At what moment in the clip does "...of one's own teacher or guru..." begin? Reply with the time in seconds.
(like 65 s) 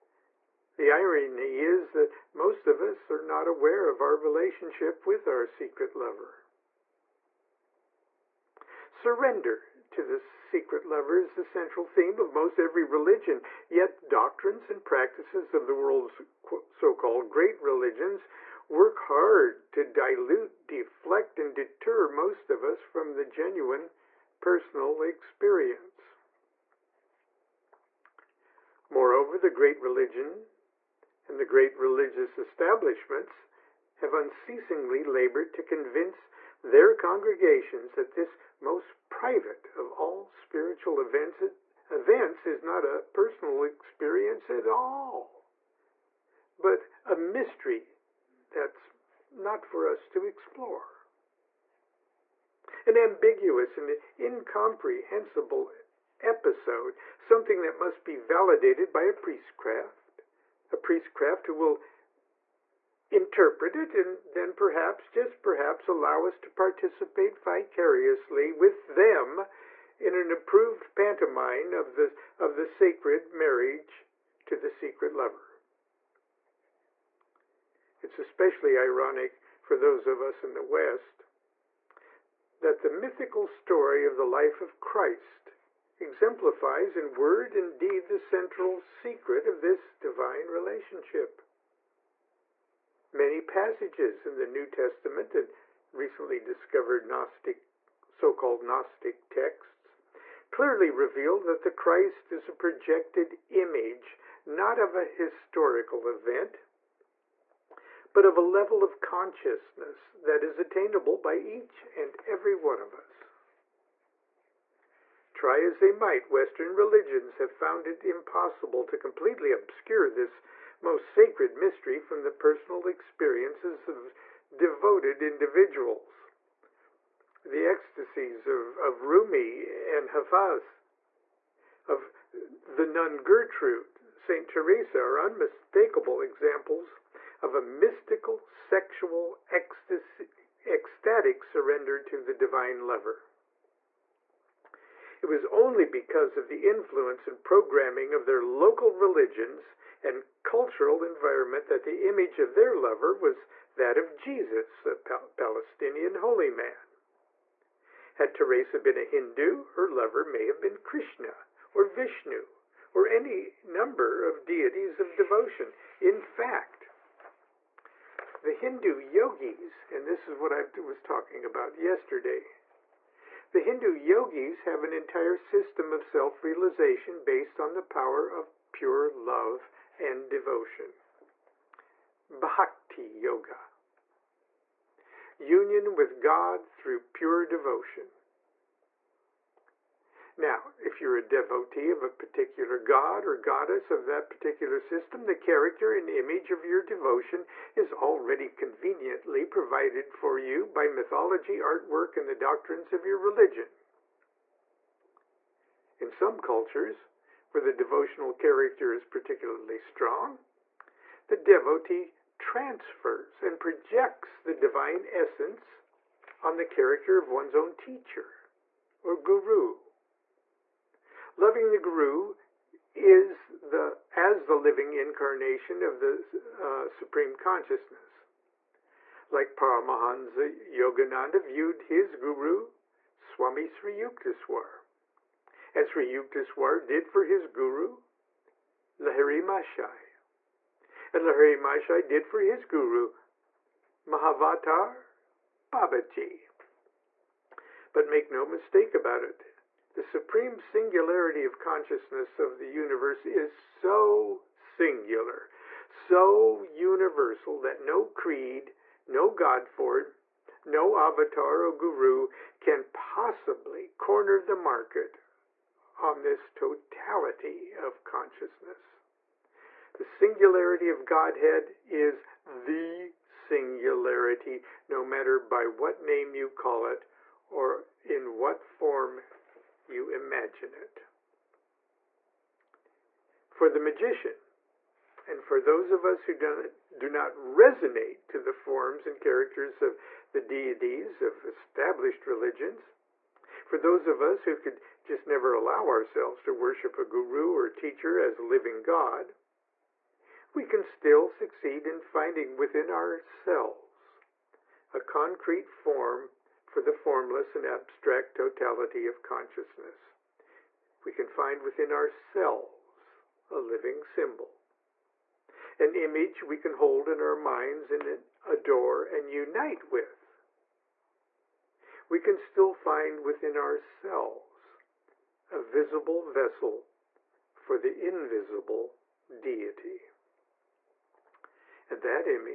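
217 s.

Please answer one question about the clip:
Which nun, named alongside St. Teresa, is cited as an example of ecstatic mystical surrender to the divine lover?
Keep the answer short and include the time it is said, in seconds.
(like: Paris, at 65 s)
Gertrude, at 132 s.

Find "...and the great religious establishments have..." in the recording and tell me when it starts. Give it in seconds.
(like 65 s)
31 s.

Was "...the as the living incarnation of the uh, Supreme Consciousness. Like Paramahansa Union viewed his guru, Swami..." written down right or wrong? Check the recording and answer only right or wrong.
wrong.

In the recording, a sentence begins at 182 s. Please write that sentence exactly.
Bhakti Yoga Union with God through pure devotion.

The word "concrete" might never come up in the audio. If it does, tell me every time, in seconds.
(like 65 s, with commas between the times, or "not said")
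305 s.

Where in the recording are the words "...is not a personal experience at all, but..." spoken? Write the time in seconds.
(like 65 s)
42 s.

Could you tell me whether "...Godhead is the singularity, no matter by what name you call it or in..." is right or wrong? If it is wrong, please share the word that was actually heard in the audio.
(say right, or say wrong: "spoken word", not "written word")
right.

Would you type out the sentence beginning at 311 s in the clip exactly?
We can find within ourselves a living symbol, an image we can hold in our minds and adore and unite with.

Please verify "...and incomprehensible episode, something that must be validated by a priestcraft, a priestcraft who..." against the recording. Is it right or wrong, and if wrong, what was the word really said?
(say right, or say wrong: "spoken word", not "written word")
right.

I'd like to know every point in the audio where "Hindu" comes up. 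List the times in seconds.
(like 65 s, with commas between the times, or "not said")
159 s, 168 s, 173 s.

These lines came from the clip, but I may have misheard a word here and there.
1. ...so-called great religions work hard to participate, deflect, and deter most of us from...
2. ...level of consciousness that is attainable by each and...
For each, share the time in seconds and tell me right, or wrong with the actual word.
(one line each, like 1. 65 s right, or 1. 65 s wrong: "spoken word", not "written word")
1. 16 s wrong: "dilute", not "participate"
2. 108 s right.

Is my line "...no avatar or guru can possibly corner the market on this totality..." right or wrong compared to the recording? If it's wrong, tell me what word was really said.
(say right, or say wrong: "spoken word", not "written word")
right.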